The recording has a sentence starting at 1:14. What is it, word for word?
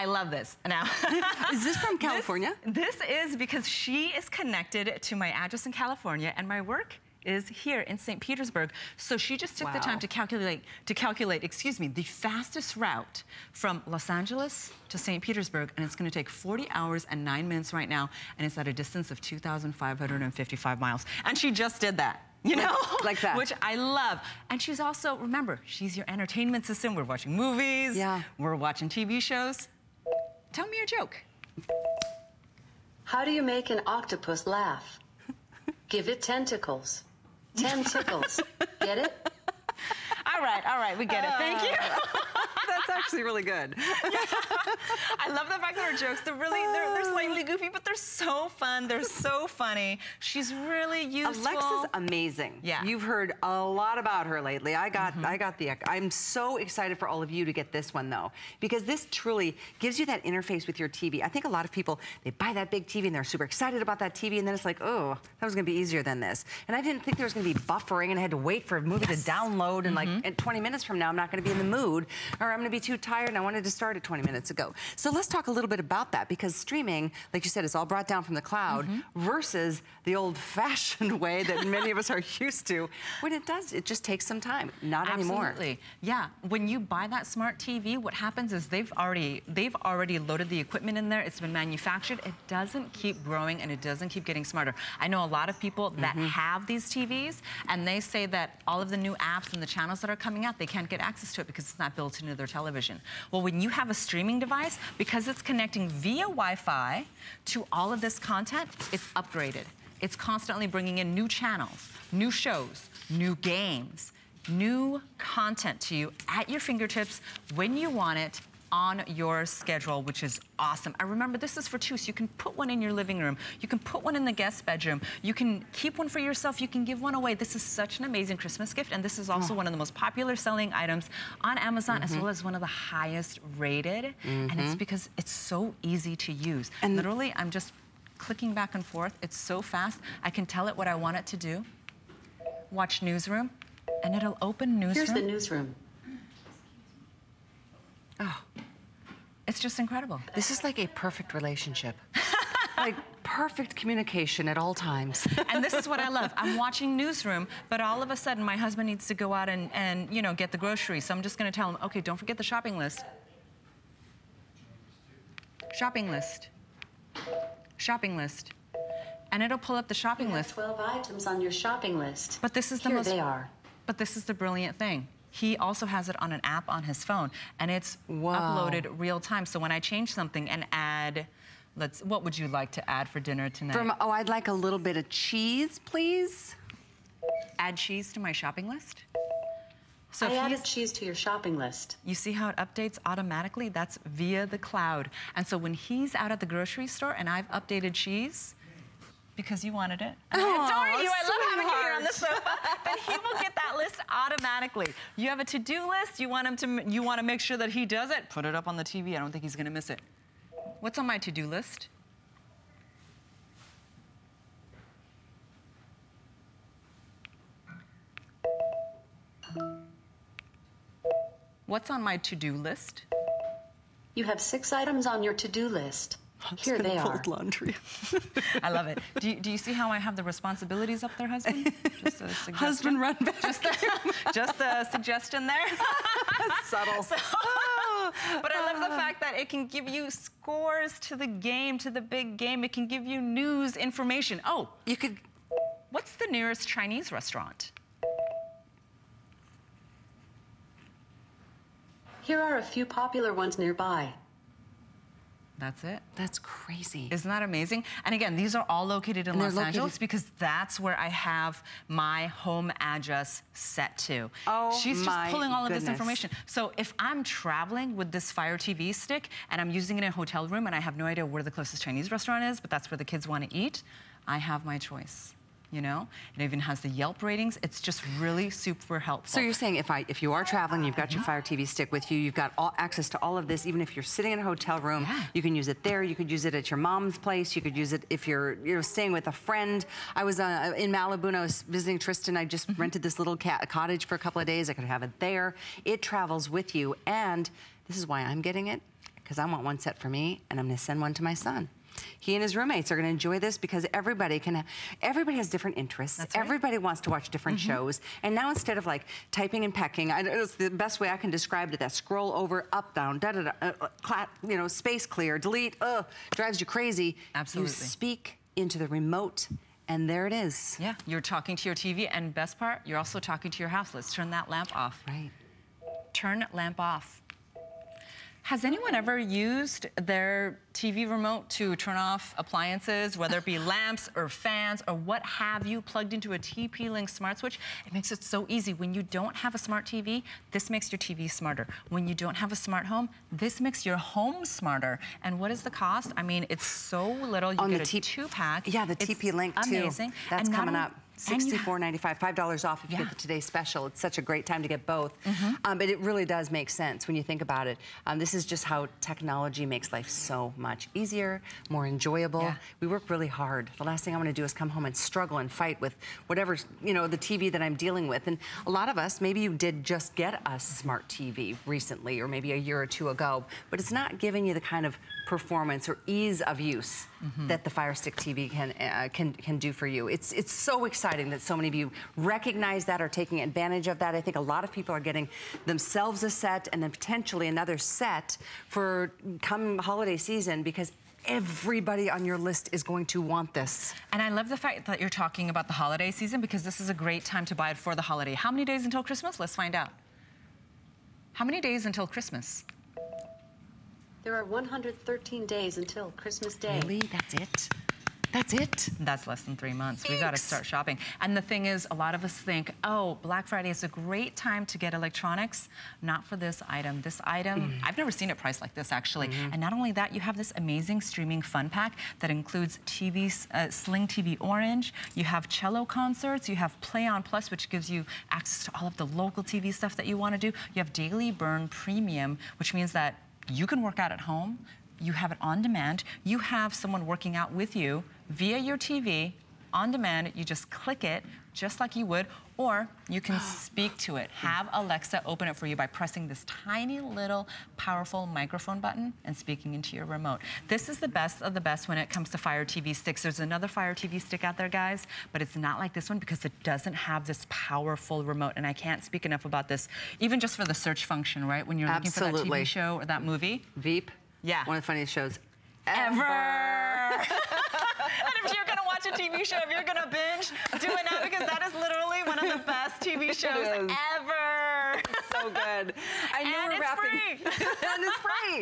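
So let's talk a little bit about that because streaming, like you said, is all brought down from the cloud mm -hmm.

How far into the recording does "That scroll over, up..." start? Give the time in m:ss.
5:11.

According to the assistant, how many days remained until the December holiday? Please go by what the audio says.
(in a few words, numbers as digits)
113.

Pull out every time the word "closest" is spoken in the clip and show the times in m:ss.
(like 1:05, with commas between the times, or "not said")
4:31.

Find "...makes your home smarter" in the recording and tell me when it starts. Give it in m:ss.
5:43.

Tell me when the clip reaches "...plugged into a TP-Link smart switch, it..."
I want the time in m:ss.
5:35.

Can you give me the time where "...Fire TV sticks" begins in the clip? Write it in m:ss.
7:32.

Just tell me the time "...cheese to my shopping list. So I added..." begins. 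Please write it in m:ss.
3:07.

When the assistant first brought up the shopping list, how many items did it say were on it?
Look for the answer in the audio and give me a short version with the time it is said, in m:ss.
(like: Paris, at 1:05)
12, at 2:50.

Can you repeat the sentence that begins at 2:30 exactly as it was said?
This is like a perfect relationship.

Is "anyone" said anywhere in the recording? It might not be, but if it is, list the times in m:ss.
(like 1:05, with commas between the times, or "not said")
5:28.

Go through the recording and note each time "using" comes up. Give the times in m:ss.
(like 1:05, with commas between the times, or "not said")
4:29.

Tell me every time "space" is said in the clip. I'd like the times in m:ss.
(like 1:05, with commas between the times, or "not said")
5:14.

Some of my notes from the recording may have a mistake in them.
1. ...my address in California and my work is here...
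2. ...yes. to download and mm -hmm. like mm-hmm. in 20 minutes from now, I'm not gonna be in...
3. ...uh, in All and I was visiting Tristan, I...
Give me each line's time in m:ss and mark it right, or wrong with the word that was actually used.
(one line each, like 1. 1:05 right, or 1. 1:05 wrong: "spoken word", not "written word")
1. 0:05 right
2. 1:09 right
3. 4:50 wrong: "Malibu", not "All".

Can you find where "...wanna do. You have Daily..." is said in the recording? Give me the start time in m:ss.
7:10.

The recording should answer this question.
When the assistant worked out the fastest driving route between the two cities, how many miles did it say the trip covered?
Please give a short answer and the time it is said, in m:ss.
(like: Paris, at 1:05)
2,555, at 0:19.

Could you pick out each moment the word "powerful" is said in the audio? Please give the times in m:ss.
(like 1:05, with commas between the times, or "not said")
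7:27, 7:37.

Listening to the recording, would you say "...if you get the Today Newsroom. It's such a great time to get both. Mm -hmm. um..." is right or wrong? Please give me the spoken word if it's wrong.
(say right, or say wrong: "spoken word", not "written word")
wrong: "Special", not "Newsroom".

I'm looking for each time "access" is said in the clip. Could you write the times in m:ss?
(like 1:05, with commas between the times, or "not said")
1:41, 4:42, 7:08.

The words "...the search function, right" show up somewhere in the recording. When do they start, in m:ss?
7:40.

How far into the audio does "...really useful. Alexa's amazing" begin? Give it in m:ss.
0:50.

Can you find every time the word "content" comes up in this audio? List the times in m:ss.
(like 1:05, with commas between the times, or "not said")
1:48, 1:55.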